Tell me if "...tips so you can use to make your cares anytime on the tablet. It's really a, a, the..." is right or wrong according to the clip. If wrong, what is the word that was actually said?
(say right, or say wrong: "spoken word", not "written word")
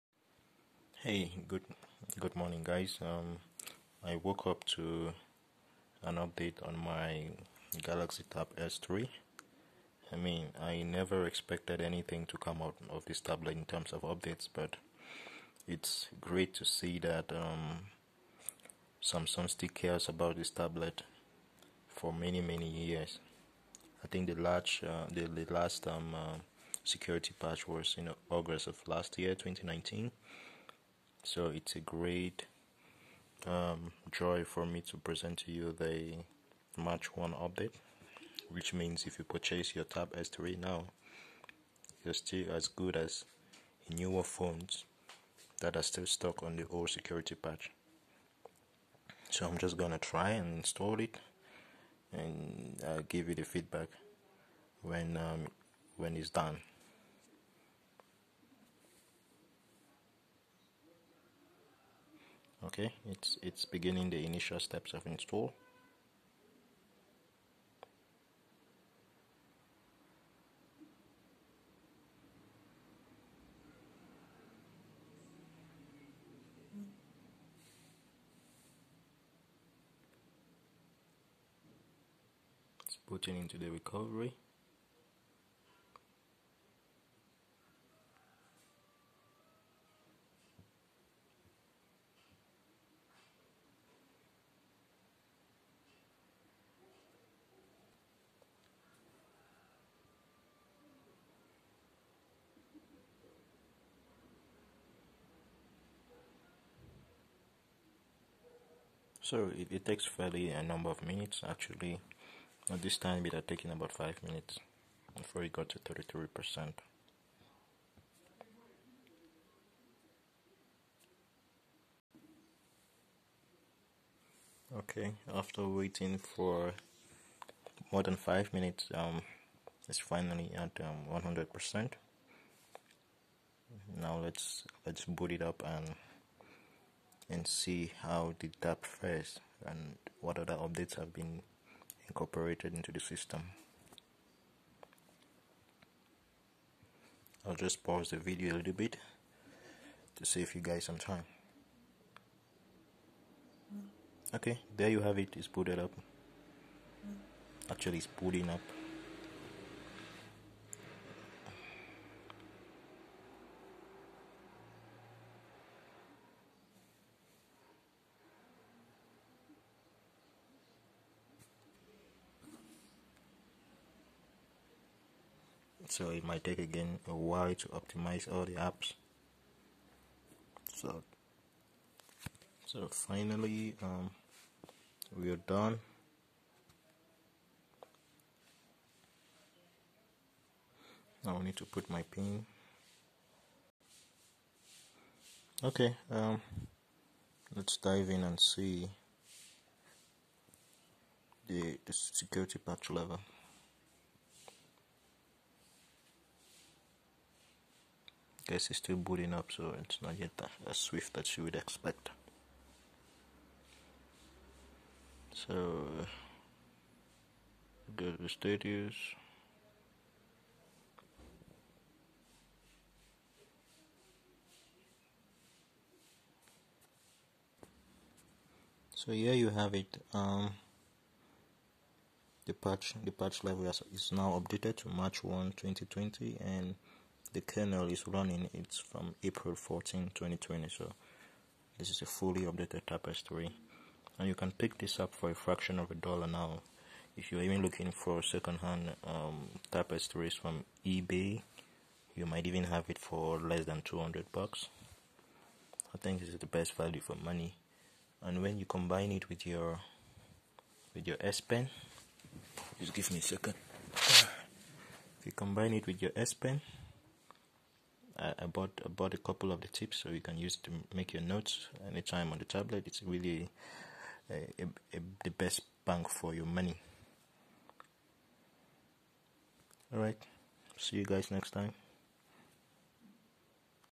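wrong: "notes", not "cares".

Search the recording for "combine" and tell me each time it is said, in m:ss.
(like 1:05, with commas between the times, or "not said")
4:18, 4:25.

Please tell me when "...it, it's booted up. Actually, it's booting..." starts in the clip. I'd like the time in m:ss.
2:35.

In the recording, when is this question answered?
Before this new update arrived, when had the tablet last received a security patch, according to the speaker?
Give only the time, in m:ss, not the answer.
0:28.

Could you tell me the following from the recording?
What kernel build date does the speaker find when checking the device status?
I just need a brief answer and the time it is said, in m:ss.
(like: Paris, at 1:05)
April 14 2020, at 3:59.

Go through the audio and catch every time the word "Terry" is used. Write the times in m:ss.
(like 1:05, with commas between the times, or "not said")
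not said.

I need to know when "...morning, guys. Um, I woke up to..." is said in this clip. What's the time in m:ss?
0:02.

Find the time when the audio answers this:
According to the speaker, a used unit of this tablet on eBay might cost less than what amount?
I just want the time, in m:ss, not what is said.
4:13.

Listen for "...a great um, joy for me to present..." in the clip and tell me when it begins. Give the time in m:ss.
0:31.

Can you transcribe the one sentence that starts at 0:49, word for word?
So I'm just gonna try and install it, and uh, give you the feedback when um, when it's done.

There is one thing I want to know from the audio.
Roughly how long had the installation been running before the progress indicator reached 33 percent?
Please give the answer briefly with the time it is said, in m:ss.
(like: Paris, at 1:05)
5 minutes, at 1:53.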